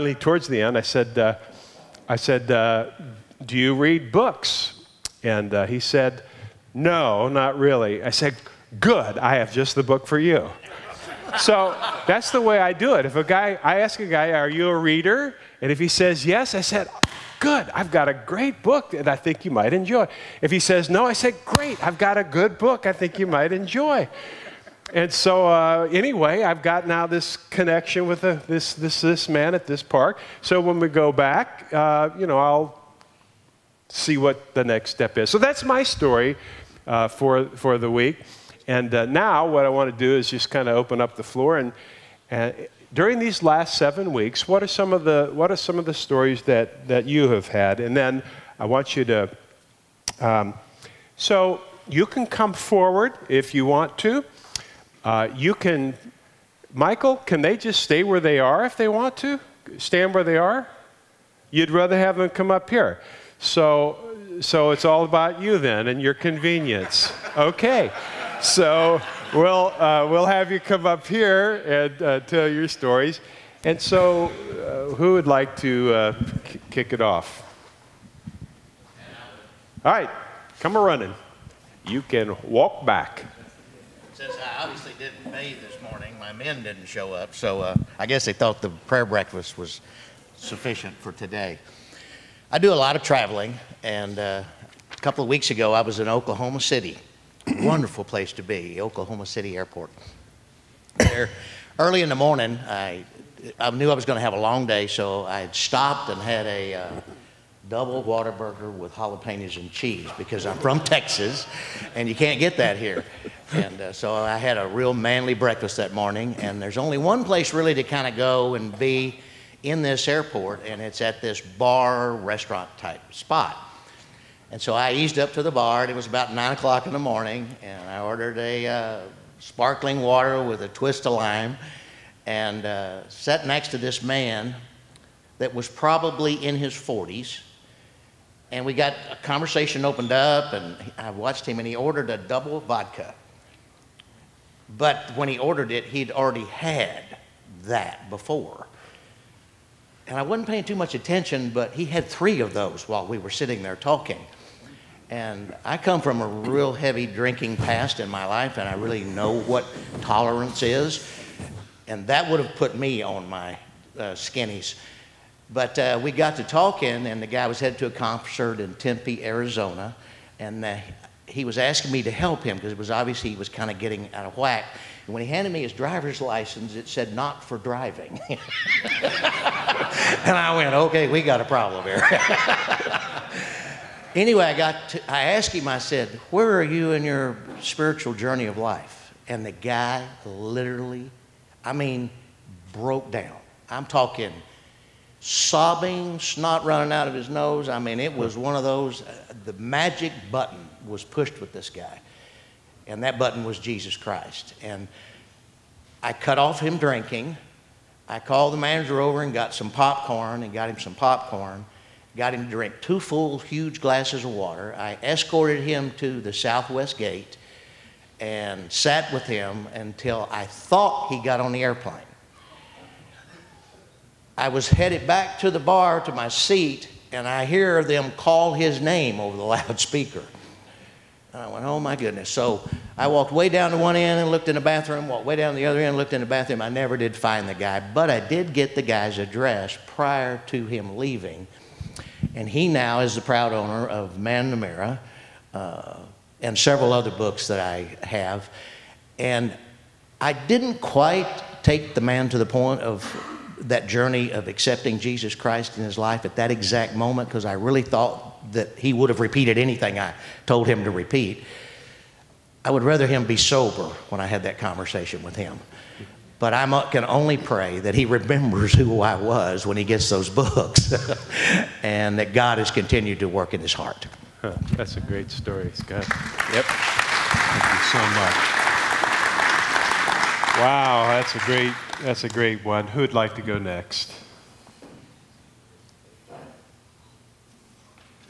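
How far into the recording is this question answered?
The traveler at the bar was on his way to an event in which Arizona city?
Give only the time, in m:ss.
2:48.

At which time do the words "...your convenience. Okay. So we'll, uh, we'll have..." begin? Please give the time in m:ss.
1:06.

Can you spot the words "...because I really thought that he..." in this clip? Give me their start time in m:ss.
4:17.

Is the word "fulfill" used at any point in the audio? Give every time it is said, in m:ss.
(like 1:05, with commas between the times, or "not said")
not said.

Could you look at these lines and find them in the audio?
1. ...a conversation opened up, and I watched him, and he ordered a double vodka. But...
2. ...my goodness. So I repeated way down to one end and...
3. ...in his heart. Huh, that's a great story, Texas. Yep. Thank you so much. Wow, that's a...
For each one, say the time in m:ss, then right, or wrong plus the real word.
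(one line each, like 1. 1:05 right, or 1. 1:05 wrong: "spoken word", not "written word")
1. 2:19 right
2. 3:51 wrong: "walked", not "repeated"
3. 4:33 wrong: "Scott", not "Texas".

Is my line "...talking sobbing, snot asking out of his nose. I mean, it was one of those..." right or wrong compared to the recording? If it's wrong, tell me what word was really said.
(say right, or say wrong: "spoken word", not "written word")
wrong: "running", not "asking".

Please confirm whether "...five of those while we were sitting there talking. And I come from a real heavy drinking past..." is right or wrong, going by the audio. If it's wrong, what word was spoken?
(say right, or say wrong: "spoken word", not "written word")
wrong: "three", not "five".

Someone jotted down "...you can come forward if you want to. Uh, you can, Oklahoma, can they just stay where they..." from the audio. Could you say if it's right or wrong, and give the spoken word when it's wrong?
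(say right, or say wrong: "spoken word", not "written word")
wrong: "Michael", not "Oklahoma".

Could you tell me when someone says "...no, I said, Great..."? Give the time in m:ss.
0:20.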